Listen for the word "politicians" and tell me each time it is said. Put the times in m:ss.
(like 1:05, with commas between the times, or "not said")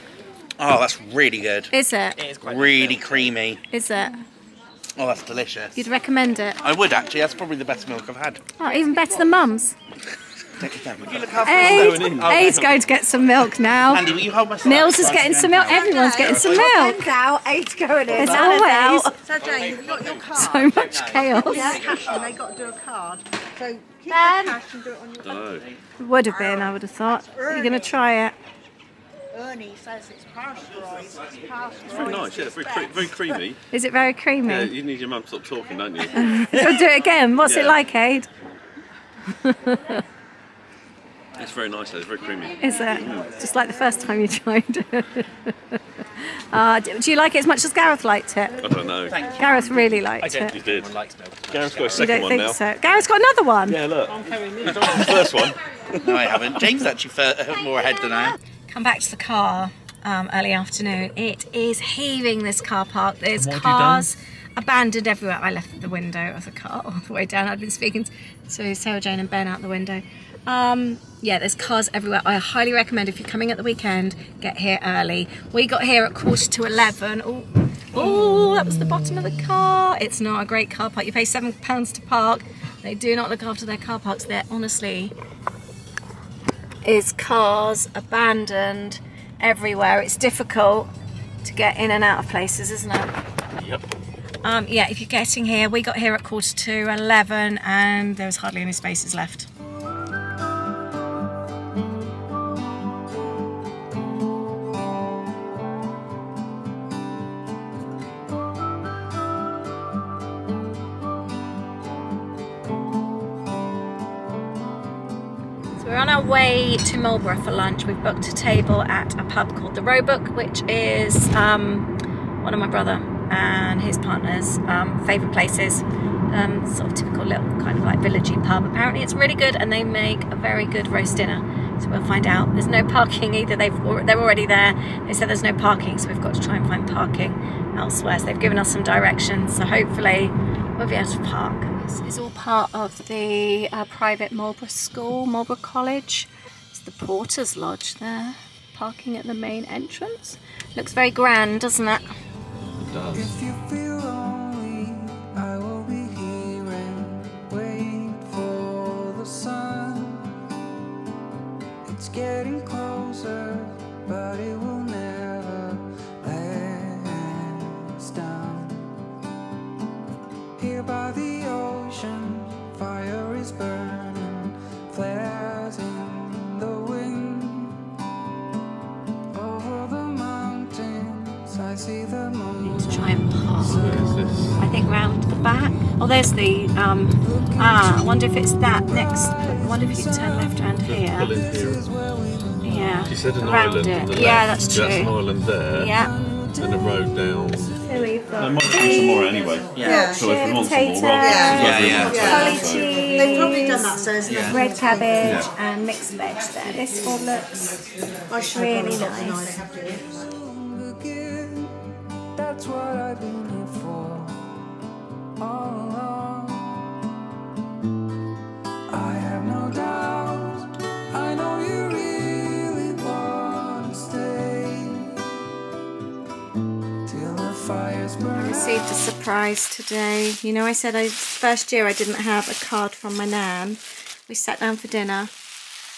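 not said.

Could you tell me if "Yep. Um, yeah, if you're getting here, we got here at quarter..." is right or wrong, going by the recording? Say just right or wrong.
right.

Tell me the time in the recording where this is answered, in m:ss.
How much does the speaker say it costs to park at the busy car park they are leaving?
1:21.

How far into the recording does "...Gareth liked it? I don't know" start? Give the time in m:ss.
0:47.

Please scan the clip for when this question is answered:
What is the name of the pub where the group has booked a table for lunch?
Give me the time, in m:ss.
1:59.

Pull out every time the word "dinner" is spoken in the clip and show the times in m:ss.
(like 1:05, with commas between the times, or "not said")
2:11, 3:54.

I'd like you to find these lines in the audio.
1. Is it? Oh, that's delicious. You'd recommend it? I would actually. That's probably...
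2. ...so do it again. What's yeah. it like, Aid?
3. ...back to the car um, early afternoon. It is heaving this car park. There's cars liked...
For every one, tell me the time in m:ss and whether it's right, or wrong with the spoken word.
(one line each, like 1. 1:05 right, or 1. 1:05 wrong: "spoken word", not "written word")
1. 0:03 right
2. 0:36 right
3. 0:58 wrong: "abandoned", not "liked".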